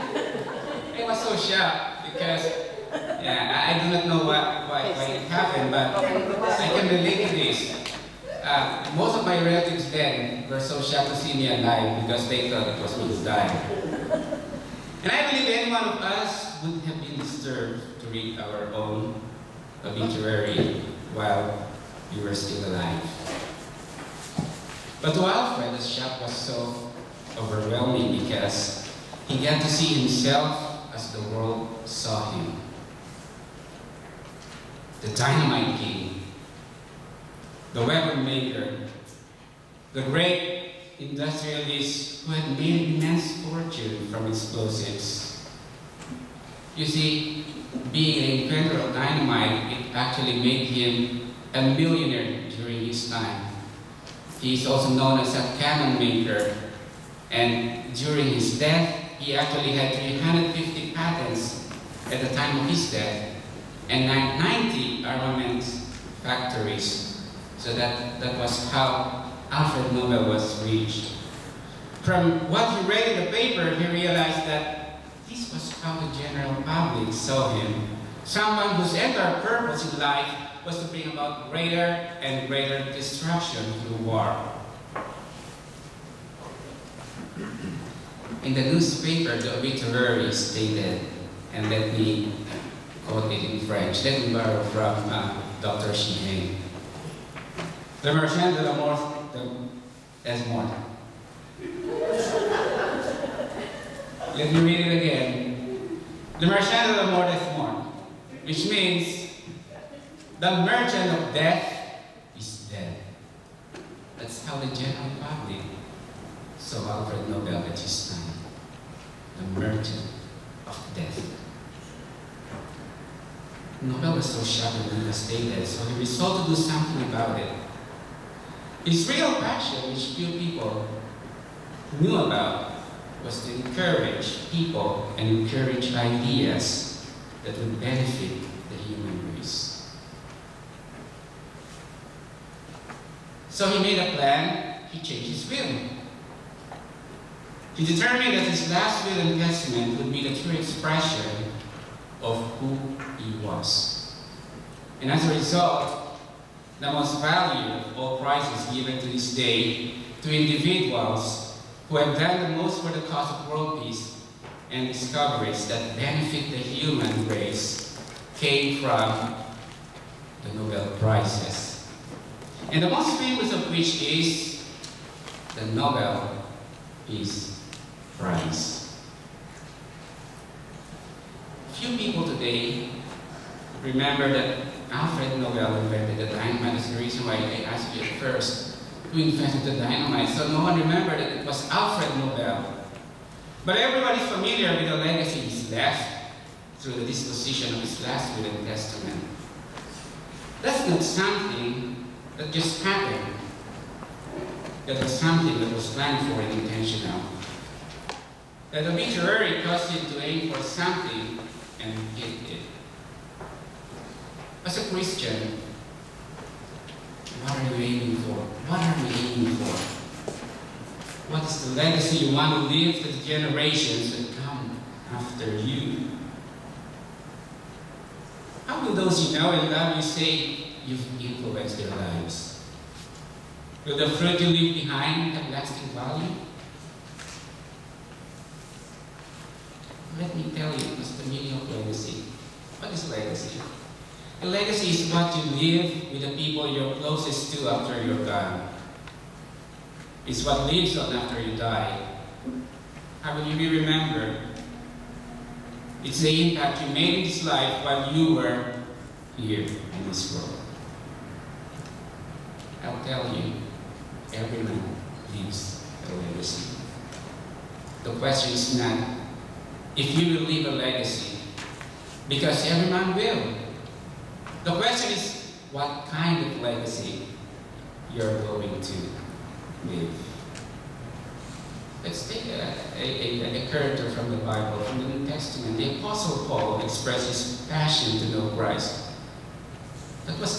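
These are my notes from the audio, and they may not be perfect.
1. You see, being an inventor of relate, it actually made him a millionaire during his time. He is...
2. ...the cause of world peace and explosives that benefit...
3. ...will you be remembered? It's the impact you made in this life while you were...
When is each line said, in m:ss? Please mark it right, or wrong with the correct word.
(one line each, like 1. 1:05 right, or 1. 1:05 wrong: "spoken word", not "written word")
1. 0:46 wrong: "dynamite", not "relate"
2. 2:42 wrong: "discoveries", not "explosives"
3. 4:13 right.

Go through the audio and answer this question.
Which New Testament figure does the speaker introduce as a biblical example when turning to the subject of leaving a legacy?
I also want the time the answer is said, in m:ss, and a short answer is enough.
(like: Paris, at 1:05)
Apostle Paul, at 4:45.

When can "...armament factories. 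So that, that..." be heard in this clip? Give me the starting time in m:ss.
1:05.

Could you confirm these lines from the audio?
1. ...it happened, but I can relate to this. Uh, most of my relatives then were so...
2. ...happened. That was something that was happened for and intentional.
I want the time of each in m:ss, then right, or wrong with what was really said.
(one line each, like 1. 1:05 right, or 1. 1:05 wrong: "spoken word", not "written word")
1. 0:05 right
2. 3:22 wrong: "planned", not "happened".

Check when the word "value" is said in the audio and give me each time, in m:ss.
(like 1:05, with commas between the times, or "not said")
2:37, 3:55.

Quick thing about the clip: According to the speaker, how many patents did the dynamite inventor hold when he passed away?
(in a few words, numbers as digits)
350.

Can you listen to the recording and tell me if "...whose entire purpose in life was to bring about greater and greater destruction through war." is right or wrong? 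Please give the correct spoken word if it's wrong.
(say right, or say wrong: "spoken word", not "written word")
right.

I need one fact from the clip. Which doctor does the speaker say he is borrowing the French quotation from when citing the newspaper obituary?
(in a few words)
Dr. Sheehan.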